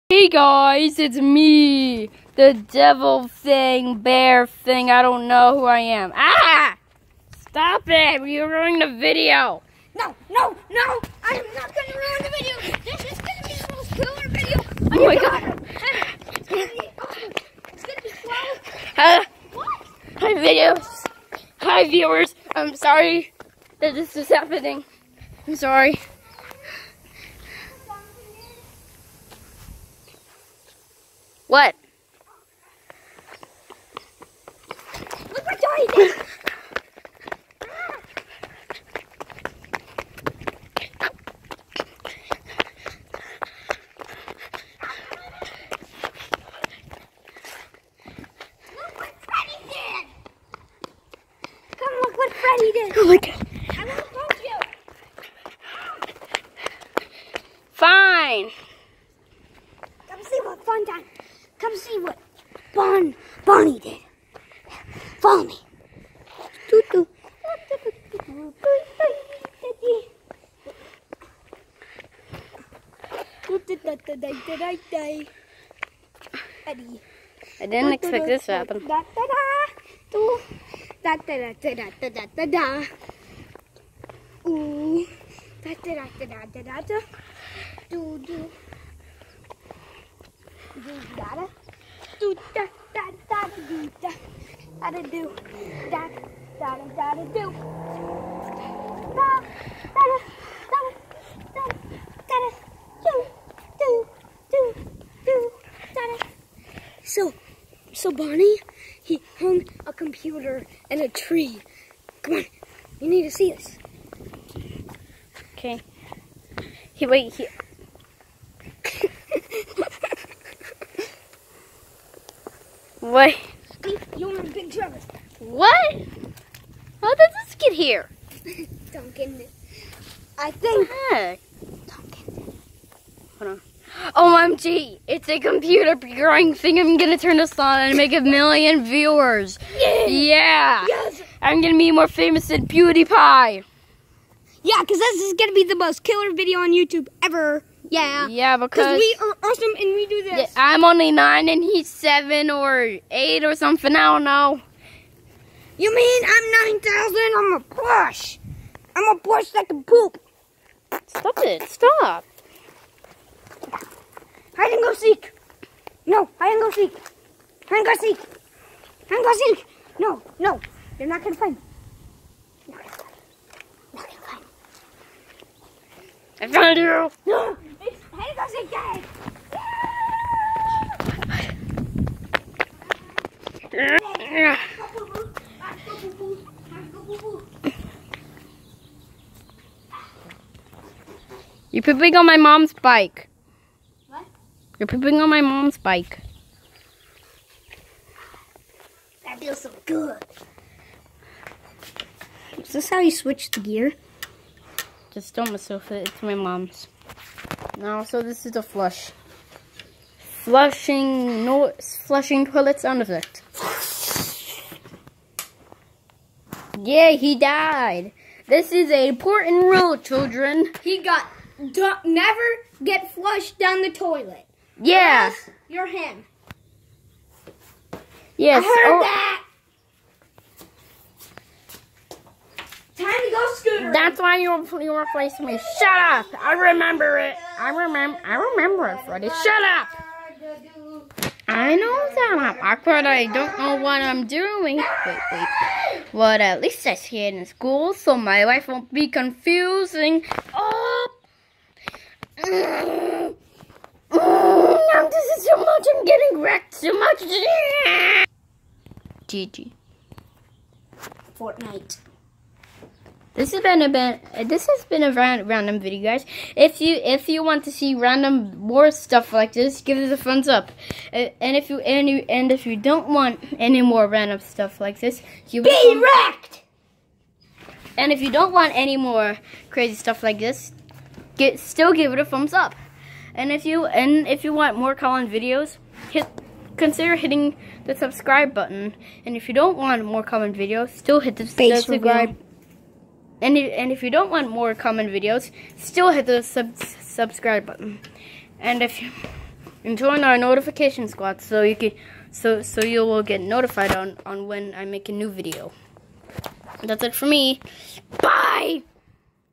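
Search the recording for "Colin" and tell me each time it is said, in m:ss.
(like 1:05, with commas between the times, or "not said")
4:44, 4:50.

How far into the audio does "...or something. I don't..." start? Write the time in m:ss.
2:33.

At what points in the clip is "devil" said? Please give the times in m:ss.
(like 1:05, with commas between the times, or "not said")
0:02.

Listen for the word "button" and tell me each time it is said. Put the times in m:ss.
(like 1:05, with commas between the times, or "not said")
4:48, 4:57.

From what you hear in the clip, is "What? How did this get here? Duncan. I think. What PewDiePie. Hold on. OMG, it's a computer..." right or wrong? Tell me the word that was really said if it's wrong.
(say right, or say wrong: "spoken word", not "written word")
wrong: "Duncan", not "PewDiePie".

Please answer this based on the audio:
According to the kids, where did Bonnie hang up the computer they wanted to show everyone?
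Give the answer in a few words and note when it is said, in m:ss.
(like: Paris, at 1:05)
A tree, at 1:51.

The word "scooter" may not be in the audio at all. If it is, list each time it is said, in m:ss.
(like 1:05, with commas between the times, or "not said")
3:53.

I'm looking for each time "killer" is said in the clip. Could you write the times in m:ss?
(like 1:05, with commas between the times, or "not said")
0:13, 2:26.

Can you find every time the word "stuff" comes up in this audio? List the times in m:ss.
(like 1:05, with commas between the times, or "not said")
4:28, 4:34, 4:39.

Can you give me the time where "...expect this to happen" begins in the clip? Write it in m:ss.
1:17.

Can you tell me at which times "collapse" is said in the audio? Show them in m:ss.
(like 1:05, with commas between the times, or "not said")
not said.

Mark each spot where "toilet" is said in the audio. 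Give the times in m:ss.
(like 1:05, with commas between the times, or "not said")
3:32, 3:43.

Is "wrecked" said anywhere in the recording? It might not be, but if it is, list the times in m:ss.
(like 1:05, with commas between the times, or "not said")
4:16, 4:36.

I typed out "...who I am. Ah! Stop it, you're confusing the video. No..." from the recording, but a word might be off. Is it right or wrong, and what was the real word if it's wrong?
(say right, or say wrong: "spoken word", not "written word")
wrong: "ruining", not "confusing".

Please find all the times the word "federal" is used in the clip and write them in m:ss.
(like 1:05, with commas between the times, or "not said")
not said.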